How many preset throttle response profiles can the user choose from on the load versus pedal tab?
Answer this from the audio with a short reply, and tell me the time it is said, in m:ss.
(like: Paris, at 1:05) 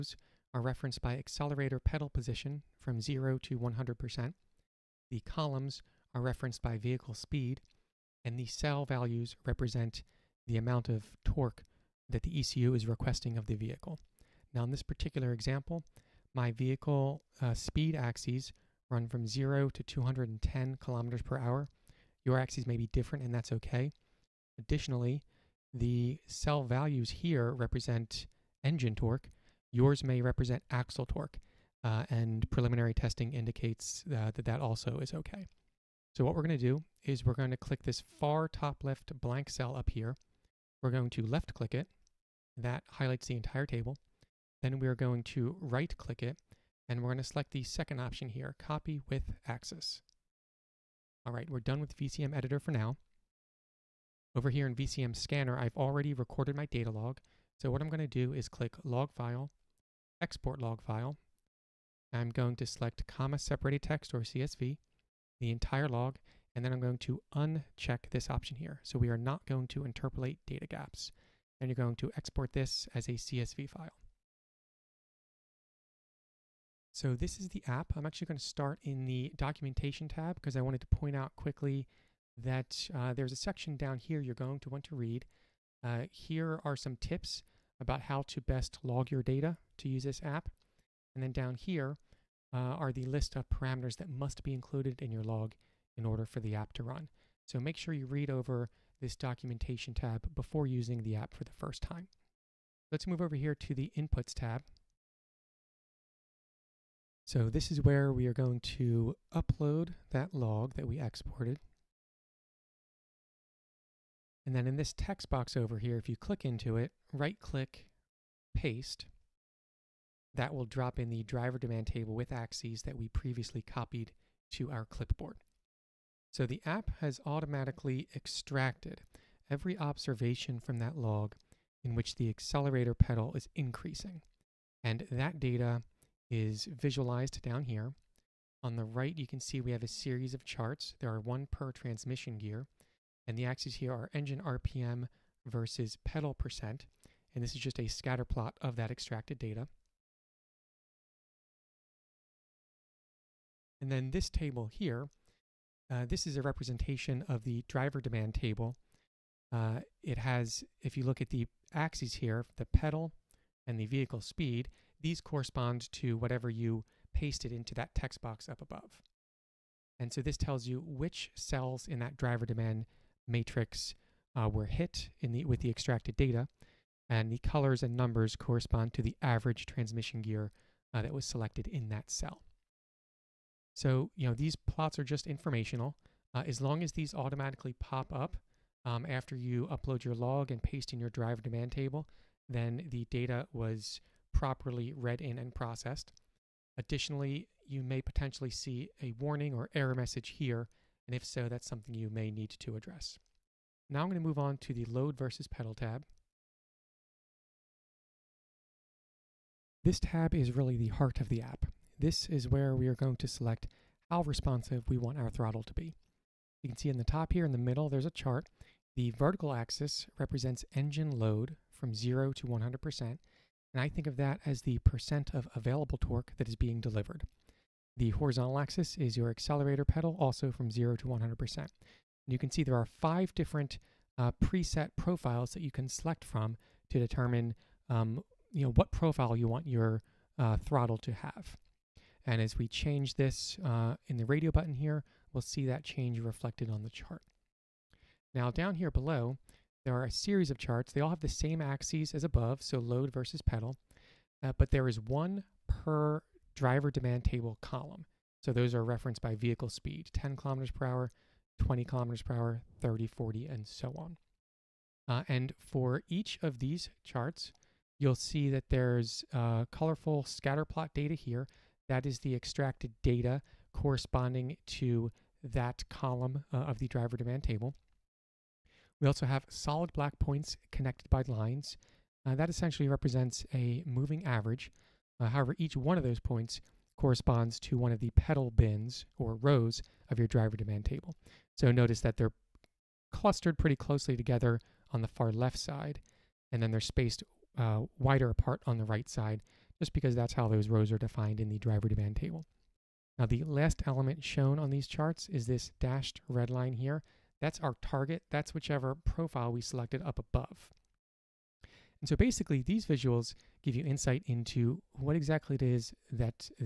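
5, at 3:52.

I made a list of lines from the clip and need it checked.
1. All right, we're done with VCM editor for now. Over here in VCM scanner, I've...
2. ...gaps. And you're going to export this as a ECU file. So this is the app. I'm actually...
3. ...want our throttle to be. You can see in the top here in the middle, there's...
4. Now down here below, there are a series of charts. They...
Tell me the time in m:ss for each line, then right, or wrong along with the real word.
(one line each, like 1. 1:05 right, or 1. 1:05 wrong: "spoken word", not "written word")
1. 0:51 right
2. 1:10 wrong: "CSV", not "ECU"
3. 3:34 right
4. 4:08 right.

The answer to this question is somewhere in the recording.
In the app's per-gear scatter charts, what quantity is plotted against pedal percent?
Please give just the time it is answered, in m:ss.
2:24.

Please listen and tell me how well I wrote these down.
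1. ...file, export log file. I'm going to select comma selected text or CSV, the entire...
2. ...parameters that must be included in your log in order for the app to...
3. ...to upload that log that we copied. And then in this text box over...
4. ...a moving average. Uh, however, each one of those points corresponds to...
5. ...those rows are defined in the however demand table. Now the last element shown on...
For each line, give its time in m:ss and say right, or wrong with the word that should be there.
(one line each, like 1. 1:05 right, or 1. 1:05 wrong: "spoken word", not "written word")
1. 0:59 wrong: "separated", not "selected"
2. 1:33 right
3. 1:48 wrong: "exported", not "copied"
4. 4:43 right
5. 5:00 wrong: "driver", not "however".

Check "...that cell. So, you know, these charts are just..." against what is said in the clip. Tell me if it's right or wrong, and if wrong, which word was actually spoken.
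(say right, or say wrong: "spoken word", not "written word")
wrong: "plots", not "charts".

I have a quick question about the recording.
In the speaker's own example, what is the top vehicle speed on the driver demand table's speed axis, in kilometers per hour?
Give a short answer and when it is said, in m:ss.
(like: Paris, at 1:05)
210, at 0:19.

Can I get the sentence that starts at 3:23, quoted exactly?
Now I'm going to move on to the load versus pedal tab.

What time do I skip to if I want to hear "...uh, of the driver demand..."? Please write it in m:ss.
4:36.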